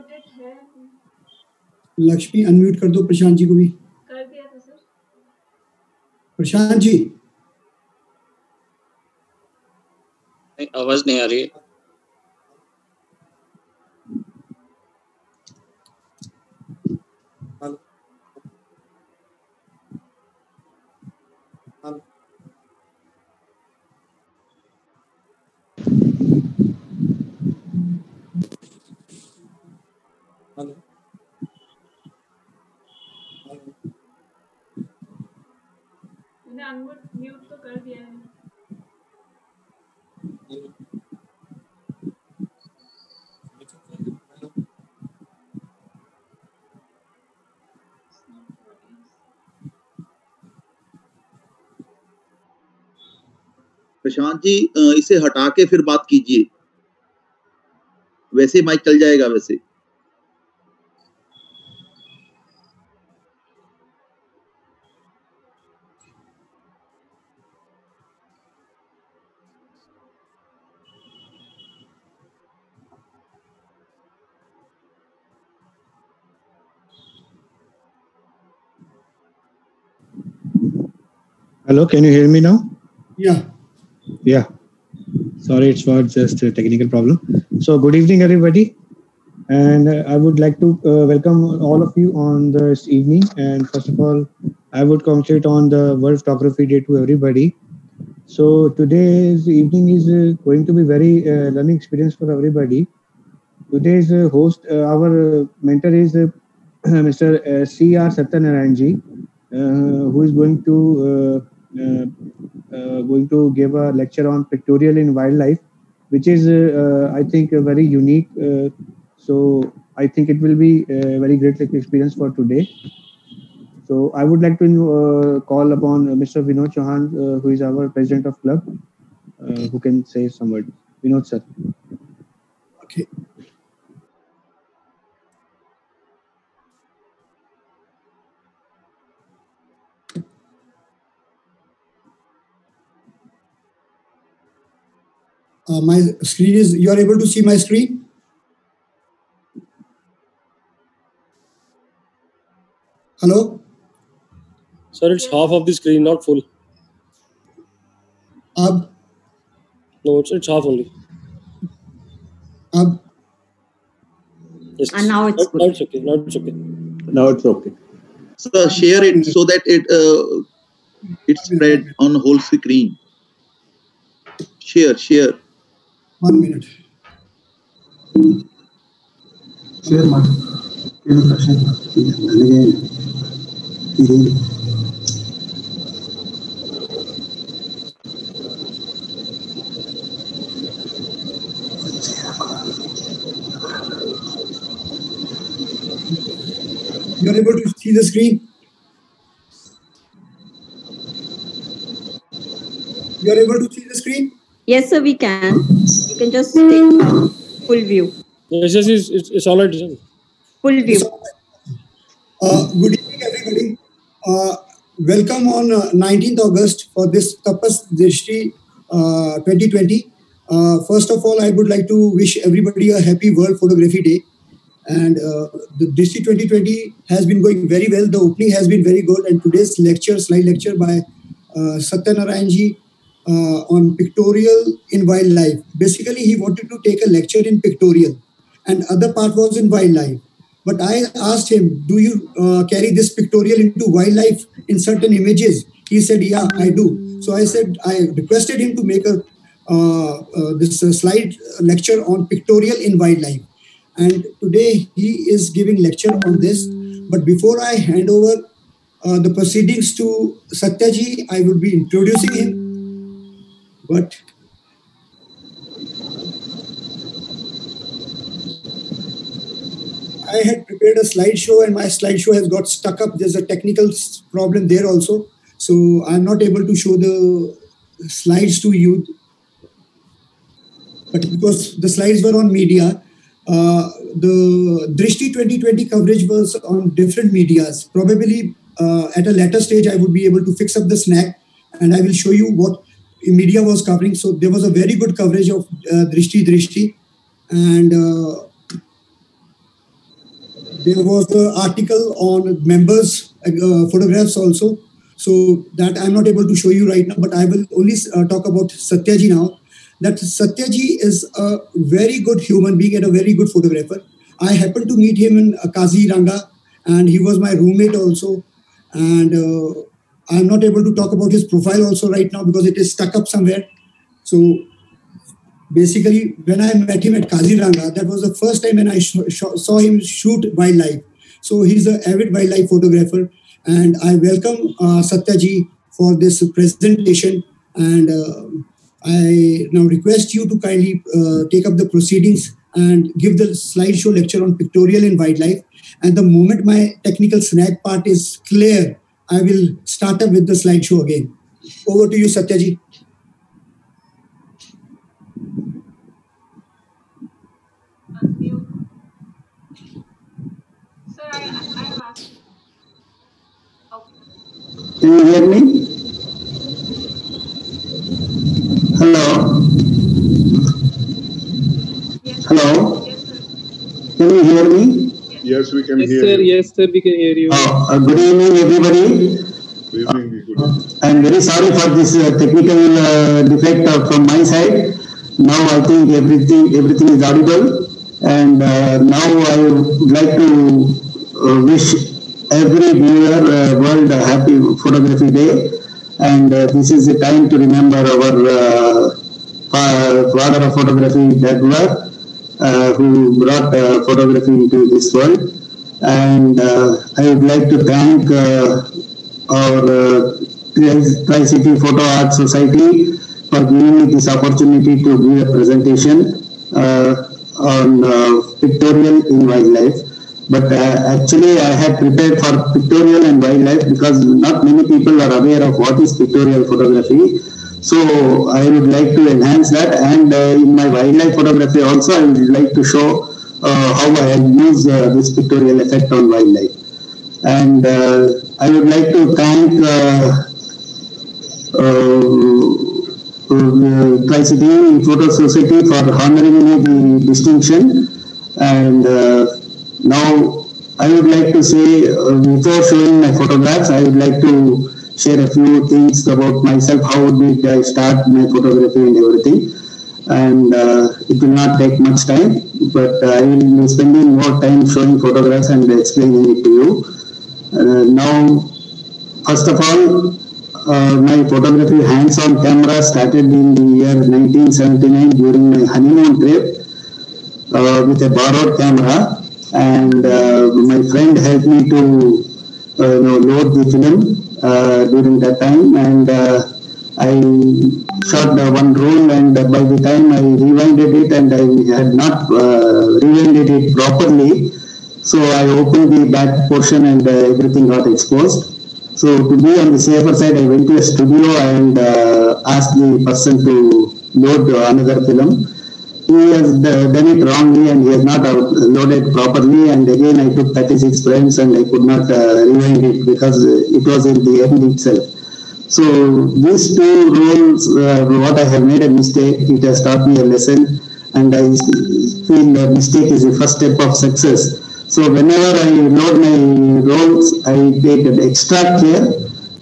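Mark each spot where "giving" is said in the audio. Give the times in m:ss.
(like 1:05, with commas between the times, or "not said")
4:15, 6:53.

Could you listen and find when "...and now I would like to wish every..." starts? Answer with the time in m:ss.
6:28.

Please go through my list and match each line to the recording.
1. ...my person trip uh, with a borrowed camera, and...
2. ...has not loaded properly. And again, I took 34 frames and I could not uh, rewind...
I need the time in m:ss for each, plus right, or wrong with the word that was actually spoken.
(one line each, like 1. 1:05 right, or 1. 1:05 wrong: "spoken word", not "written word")
1. 7:55 wrong: "honeymoon", not "person"
2. 8:28 wrong: "36", not "34".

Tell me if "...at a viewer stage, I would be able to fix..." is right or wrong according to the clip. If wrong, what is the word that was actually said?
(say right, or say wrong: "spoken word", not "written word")
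wrong: "later", not "viewer".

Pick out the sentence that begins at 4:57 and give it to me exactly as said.
And uh, there was an article on members' uh, photographs also.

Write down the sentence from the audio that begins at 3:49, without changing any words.
And today's lecture, slide lecture by uh, Satya Narayanji uh, on pictorial in wildlife.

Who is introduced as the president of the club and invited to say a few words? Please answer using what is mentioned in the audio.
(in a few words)
Vinod Chauhan.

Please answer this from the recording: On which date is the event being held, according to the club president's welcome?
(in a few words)
19th August.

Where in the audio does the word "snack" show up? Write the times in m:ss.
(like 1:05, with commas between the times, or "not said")
4:50, 5:47.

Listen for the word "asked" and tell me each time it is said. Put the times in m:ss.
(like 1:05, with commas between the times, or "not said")
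4:01, 8:22.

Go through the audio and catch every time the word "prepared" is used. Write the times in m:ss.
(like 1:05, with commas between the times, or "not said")
4:30, 7:01.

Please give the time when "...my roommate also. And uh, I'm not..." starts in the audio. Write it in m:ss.
5:17.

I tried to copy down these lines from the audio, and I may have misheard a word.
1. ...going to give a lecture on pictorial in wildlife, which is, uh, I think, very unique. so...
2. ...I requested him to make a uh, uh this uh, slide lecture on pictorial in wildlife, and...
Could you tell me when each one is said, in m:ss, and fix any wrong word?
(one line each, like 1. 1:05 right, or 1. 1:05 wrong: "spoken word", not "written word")
1. 1:53 right
2. 4:07 right.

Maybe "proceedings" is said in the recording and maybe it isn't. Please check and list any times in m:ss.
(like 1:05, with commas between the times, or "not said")
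4:19, 5:41.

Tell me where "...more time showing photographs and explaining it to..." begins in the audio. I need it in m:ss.
7:44.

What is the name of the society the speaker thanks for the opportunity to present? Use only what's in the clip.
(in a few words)
Tri City Photo Art Society.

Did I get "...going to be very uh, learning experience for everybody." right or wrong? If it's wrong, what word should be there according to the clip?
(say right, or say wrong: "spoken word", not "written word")
right.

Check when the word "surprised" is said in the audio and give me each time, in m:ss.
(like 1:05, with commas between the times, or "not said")
not said.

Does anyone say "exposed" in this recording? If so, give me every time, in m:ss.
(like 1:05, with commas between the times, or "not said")
8:18.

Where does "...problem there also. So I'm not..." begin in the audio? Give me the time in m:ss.
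4:34.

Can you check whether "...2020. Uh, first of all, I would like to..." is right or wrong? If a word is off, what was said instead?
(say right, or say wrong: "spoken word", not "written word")
right.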